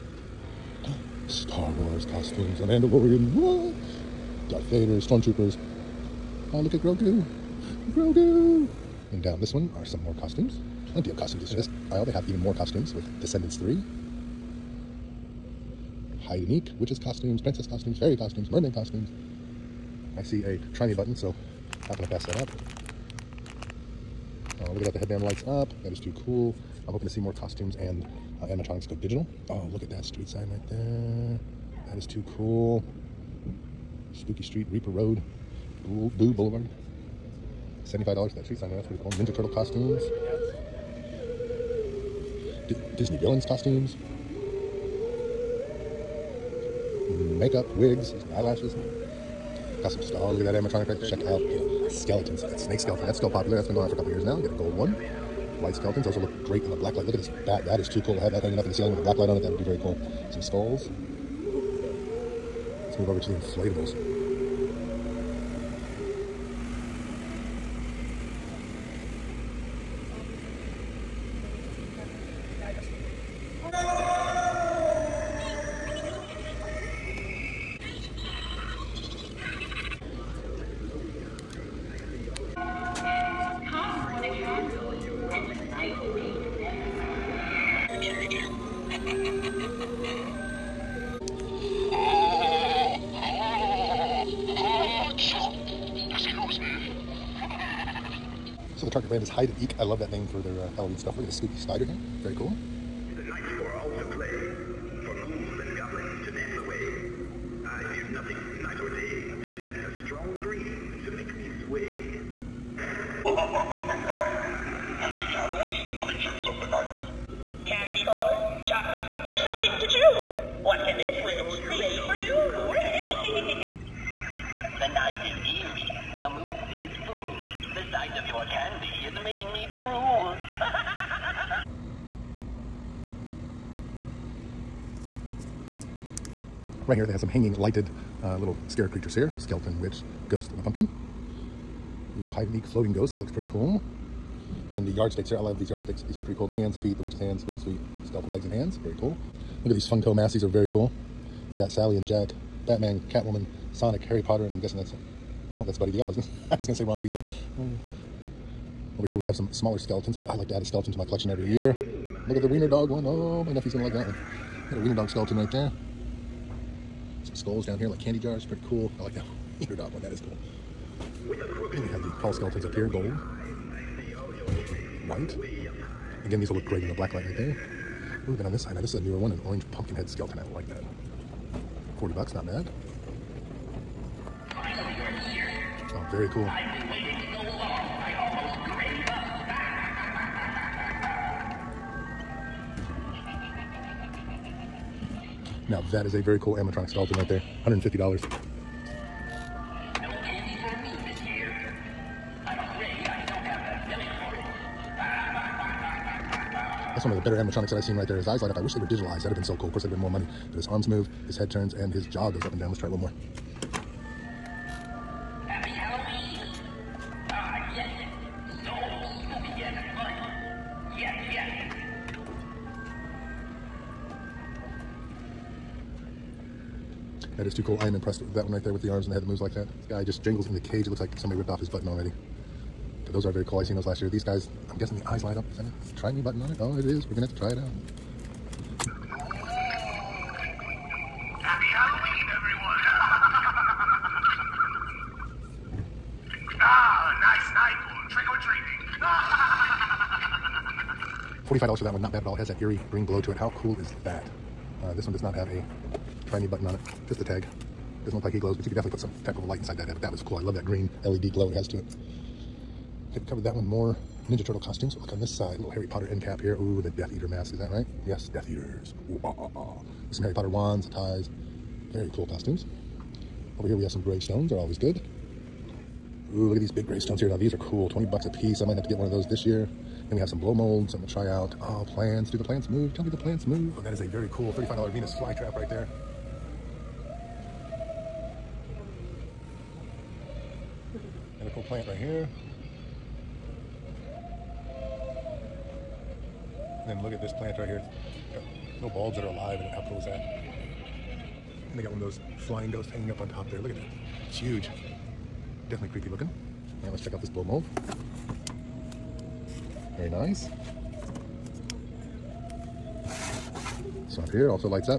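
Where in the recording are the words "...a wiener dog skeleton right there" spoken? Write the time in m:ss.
2:44.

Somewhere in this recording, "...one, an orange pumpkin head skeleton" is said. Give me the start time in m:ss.
2:59.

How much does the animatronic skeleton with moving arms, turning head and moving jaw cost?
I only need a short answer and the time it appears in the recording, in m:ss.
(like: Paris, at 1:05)
$150, at 3:17.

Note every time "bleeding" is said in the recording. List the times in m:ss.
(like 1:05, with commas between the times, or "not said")
not said.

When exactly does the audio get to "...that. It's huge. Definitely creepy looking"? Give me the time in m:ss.
5:03.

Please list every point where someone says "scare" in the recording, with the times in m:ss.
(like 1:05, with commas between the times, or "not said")
2:18.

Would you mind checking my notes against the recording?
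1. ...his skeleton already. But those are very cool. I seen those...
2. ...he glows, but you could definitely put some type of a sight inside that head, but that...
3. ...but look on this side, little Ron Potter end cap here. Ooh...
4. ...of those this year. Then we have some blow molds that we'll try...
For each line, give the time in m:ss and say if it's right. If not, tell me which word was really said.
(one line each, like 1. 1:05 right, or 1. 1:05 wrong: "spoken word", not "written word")
1. 3:51 wrong: "button", not "skeleton"
2. 4:18 wrong: "light", not "sight"
3. 4:24 wrong: "Harry", not "Ron"
4. 4:39 right.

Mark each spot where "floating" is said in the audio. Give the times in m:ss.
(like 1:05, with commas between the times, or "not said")
2:22.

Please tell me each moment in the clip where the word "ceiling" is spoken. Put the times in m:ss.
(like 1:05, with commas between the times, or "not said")
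0:58.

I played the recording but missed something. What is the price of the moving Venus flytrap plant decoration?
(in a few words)
$35.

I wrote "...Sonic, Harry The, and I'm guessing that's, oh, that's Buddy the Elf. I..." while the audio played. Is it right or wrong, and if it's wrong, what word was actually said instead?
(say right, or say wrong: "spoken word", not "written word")
wrong: "Potter", not "The".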